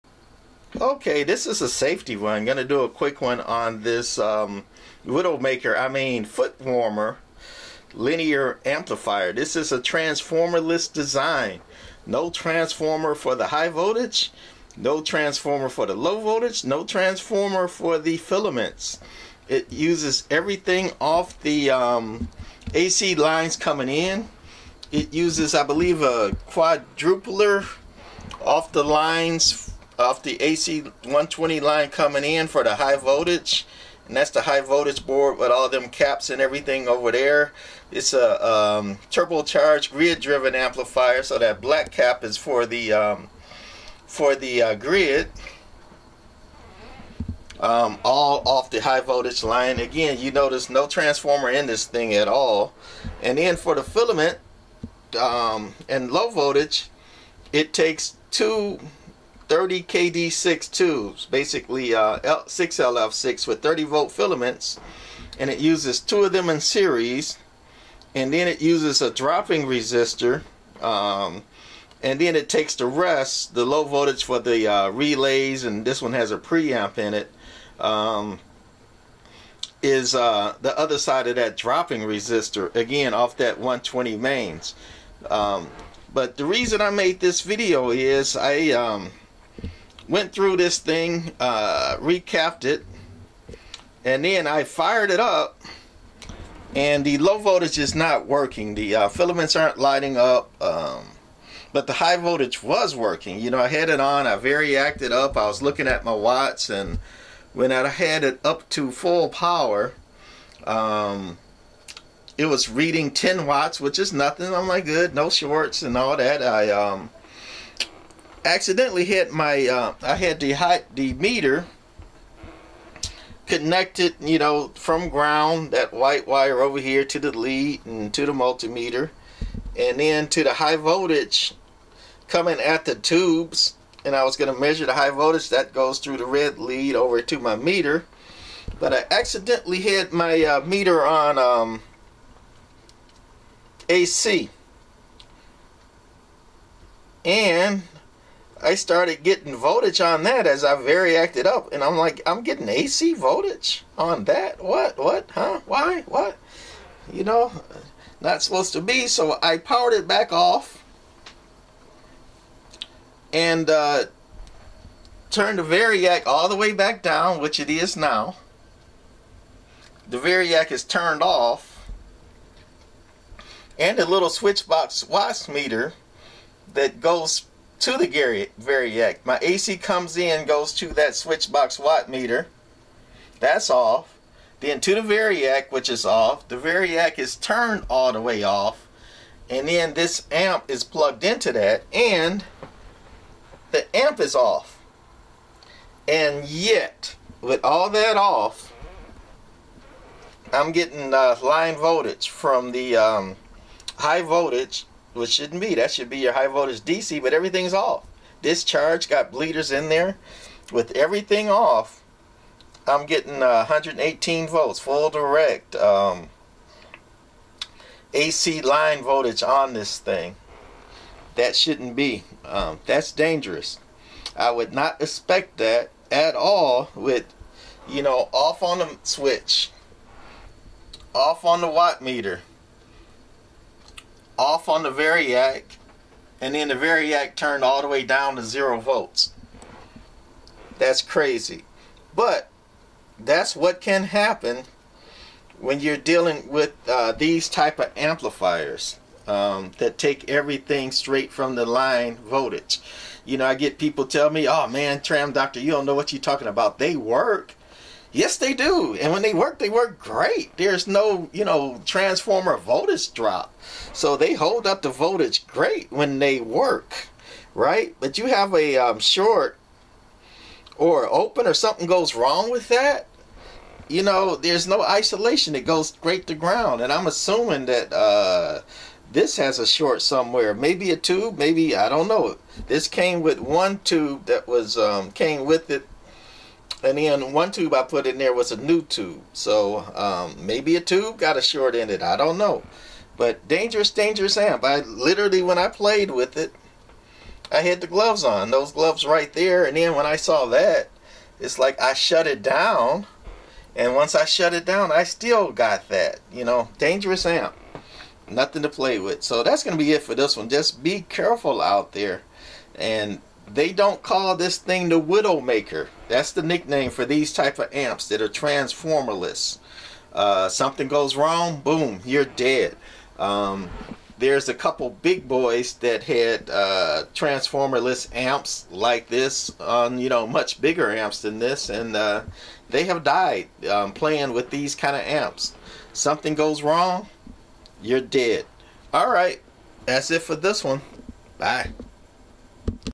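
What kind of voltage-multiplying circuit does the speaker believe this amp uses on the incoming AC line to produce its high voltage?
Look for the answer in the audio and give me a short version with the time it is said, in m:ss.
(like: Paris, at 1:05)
quadrupler, at 0:26.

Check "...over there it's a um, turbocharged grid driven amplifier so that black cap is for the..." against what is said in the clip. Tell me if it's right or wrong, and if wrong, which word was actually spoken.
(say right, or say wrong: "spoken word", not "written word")
right.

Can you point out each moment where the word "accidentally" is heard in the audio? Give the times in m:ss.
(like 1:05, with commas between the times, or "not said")
1:58, 2:19.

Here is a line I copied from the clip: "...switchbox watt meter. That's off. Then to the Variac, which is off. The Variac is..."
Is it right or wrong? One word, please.
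right.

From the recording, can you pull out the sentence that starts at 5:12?
And they don't call this thing the Widowmaker.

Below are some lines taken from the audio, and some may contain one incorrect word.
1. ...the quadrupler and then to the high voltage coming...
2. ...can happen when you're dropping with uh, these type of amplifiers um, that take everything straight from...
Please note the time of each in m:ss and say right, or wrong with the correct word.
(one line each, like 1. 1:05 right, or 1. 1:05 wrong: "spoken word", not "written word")
1. 2:08 wrong: "multimeter", not "quadrupler"
2. 4:03 wrong: "dealing", not "dropping".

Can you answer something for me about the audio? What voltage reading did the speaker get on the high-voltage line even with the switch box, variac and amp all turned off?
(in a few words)
118 volts.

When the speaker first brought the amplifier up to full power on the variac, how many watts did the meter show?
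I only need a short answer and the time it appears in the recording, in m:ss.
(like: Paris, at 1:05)
10 watts, at 1:53.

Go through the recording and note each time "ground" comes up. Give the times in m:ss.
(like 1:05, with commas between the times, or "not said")
2:05, 4:36.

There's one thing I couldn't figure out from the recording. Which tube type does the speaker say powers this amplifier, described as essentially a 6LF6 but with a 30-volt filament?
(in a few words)
30KD6.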